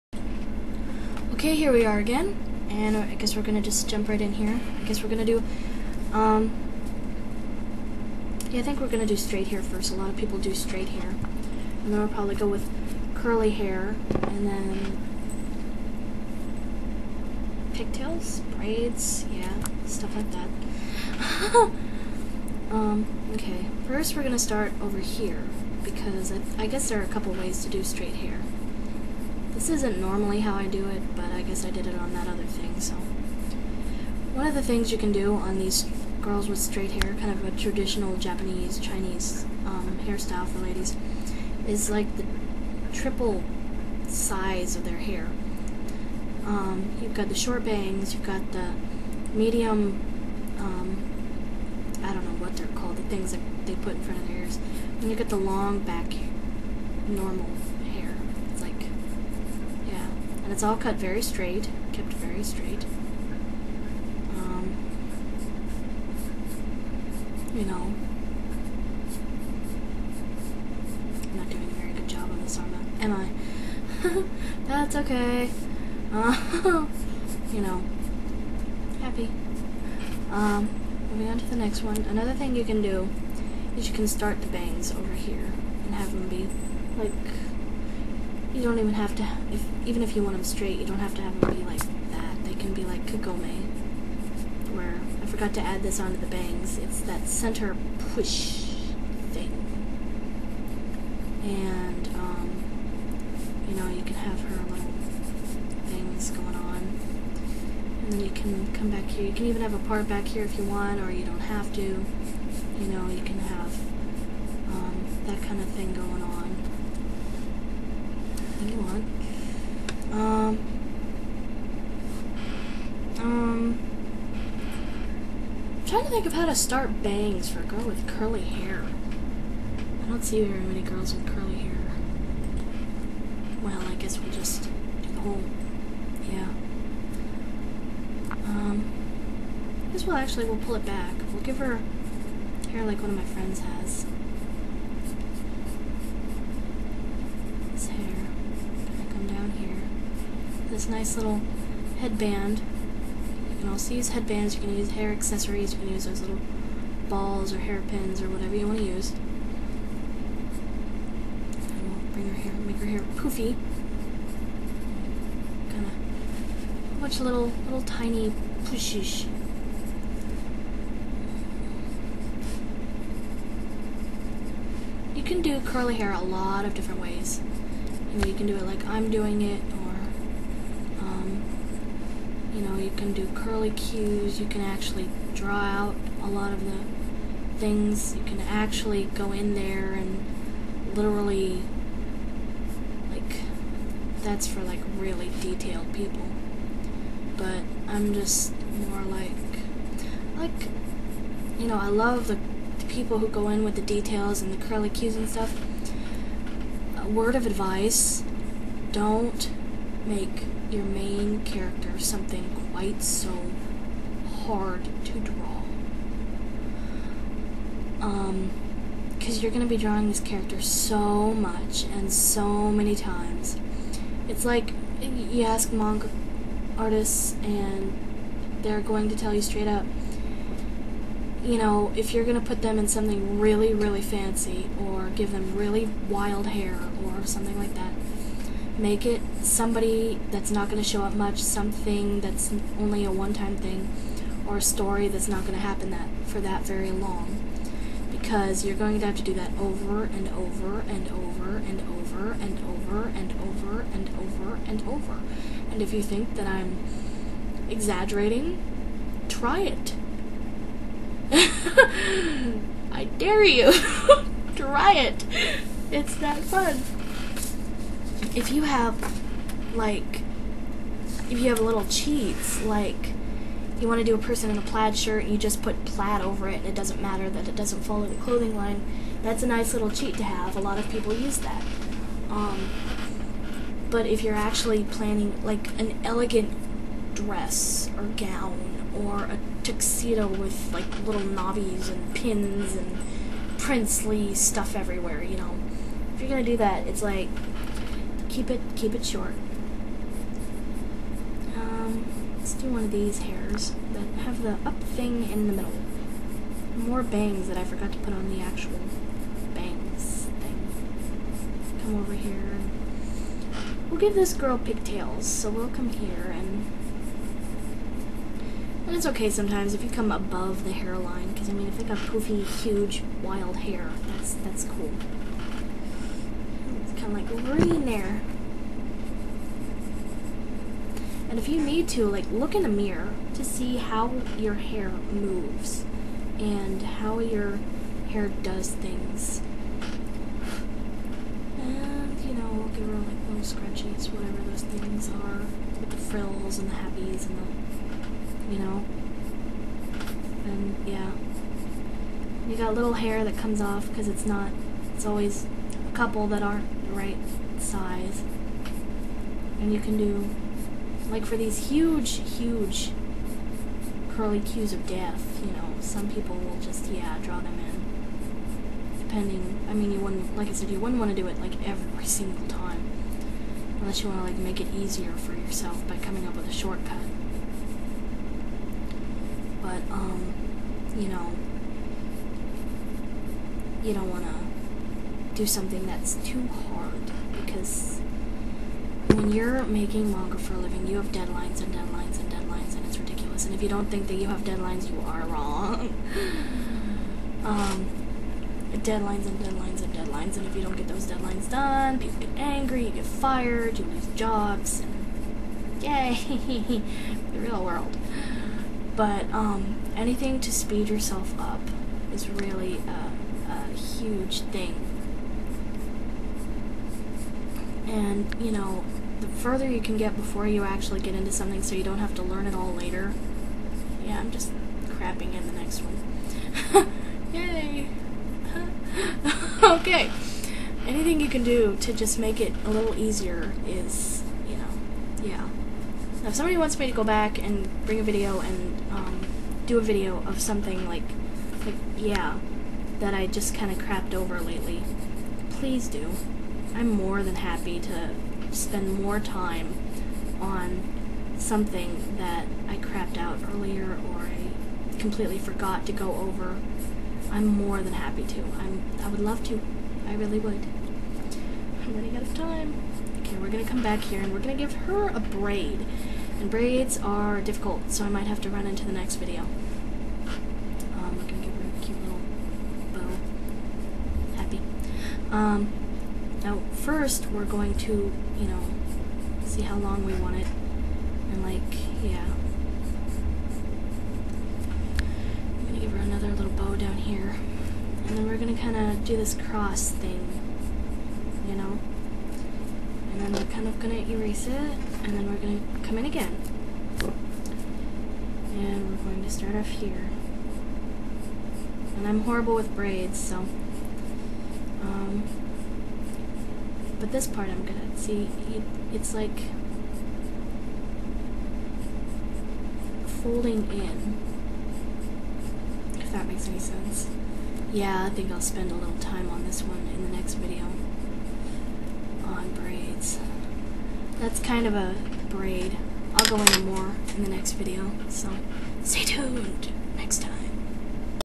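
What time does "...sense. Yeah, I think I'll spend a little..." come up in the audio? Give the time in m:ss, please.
8:36.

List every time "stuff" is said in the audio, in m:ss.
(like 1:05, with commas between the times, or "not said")
0:19, 3:25, 4:54.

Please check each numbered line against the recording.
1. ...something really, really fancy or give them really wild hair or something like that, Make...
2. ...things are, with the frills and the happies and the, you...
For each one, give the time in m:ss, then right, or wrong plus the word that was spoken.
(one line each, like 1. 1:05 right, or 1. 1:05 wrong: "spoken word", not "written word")
1. 3:52 right
2. 5:44 right.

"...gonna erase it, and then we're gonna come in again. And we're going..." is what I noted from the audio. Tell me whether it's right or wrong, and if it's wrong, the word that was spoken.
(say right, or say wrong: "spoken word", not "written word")
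right.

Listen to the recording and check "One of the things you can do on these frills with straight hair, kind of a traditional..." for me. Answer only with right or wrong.
wrong.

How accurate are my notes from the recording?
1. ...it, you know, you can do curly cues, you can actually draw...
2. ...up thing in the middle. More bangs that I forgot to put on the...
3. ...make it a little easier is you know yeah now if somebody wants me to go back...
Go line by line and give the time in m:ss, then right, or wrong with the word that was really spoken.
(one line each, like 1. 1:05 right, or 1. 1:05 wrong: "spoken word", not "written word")
1. 2:59 right
2. 5:04 right
3. 7:12 right.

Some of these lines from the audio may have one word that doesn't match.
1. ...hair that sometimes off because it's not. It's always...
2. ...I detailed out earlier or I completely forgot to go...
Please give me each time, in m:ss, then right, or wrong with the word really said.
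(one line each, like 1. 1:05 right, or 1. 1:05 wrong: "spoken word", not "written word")
1. 5:52 wrong: "comes", not "sometimes"
2. 7:32 wrong: "crapped", not "detailed".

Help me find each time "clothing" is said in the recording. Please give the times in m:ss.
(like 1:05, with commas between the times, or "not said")
4:38.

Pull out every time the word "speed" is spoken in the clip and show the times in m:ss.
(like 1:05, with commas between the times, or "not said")
6:50.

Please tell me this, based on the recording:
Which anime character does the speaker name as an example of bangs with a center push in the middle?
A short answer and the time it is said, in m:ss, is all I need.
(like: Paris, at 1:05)
Kagome, at 1:33.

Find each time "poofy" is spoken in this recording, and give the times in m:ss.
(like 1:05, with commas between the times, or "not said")
2:43, 5:21.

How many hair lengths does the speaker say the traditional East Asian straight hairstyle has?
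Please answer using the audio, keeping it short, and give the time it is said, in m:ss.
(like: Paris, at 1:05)
triple, at 0:42.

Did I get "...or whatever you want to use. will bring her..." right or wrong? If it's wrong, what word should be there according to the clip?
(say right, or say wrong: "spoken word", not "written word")
right.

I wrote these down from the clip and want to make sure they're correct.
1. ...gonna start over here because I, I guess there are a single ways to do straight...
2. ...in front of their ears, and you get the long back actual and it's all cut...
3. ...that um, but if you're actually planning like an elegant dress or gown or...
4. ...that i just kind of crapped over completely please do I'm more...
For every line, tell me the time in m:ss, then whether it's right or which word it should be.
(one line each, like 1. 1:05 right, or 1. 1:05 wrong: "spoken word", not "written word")
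1. 0:24 wrong: "couple", not "single"
2. 0:53 wrong: "normal", not "actual"
3. 4:41 right
4. 7:22 wrong: "lately", not "completely".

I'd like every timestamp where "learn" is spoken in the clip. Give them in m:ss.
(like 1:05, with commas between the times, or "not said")
7:02.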